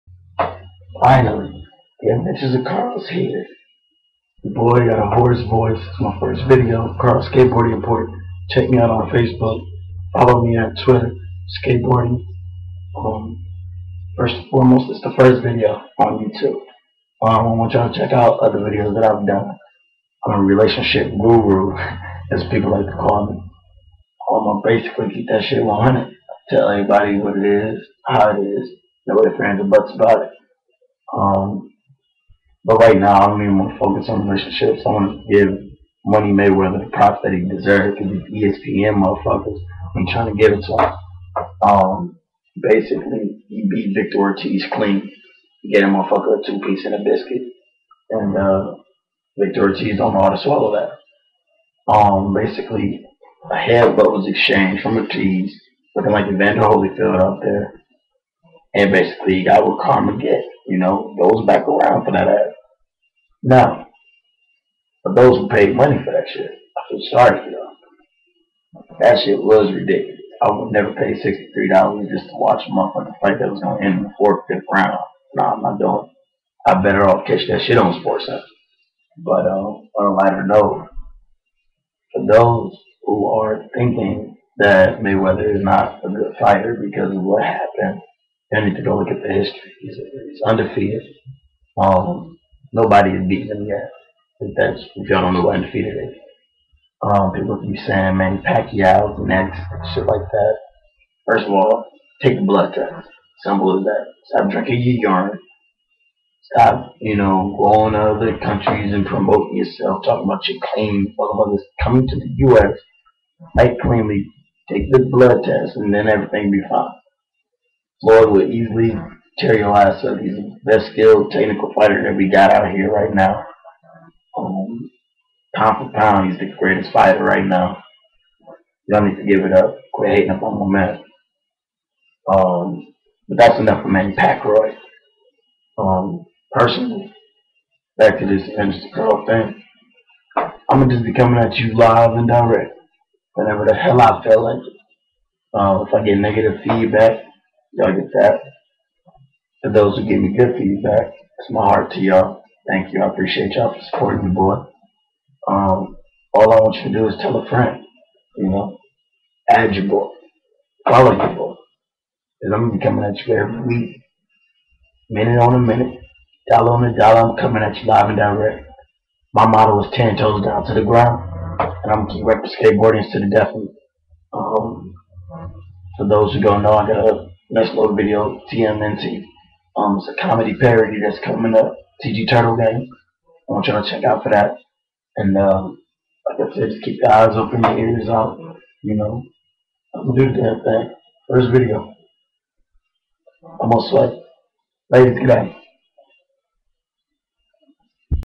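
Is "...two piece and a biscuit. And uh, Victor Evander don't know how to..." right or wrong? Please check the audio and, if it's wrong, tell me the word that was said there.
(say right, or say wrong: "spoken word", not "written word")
wrong: "Ortiz", not "Evander".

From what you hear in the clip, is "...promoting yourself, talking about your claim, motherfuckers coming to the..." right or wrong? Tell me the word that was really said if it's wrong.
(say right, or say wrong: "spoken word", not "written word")
right.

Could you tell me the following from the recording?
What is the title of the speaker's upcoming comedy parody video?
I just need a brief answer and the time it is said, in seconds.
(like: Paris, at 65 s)
TMNT, at 178 s.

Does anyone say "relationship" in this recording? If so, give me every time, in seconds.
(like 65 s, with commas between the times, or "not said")
20 s, 34 s.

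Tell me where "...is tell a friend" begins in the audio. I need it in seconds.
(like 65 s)
157 s.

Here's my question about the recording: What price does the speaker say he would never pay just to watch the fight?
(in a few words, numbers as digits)
$63.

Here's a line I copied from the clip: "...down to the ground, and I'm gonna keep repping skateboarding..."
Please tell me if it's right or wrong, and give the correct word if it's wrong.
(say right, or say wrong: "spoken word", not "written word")
right.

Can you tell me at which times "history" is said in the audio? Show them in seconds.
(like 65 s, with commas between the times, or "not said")
89 s.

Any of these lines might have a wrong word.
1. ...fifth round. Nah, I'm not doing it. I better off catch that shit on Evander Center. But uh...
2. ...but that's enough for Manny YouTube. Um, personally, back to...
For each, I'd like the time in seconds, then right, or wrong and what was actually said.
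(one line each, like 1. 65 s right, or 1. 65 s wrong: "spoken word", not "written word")
1. 74 s wrong: "Sports", not "Evander"
2. 133 s wrong: "Pacquiao", not "YouTube".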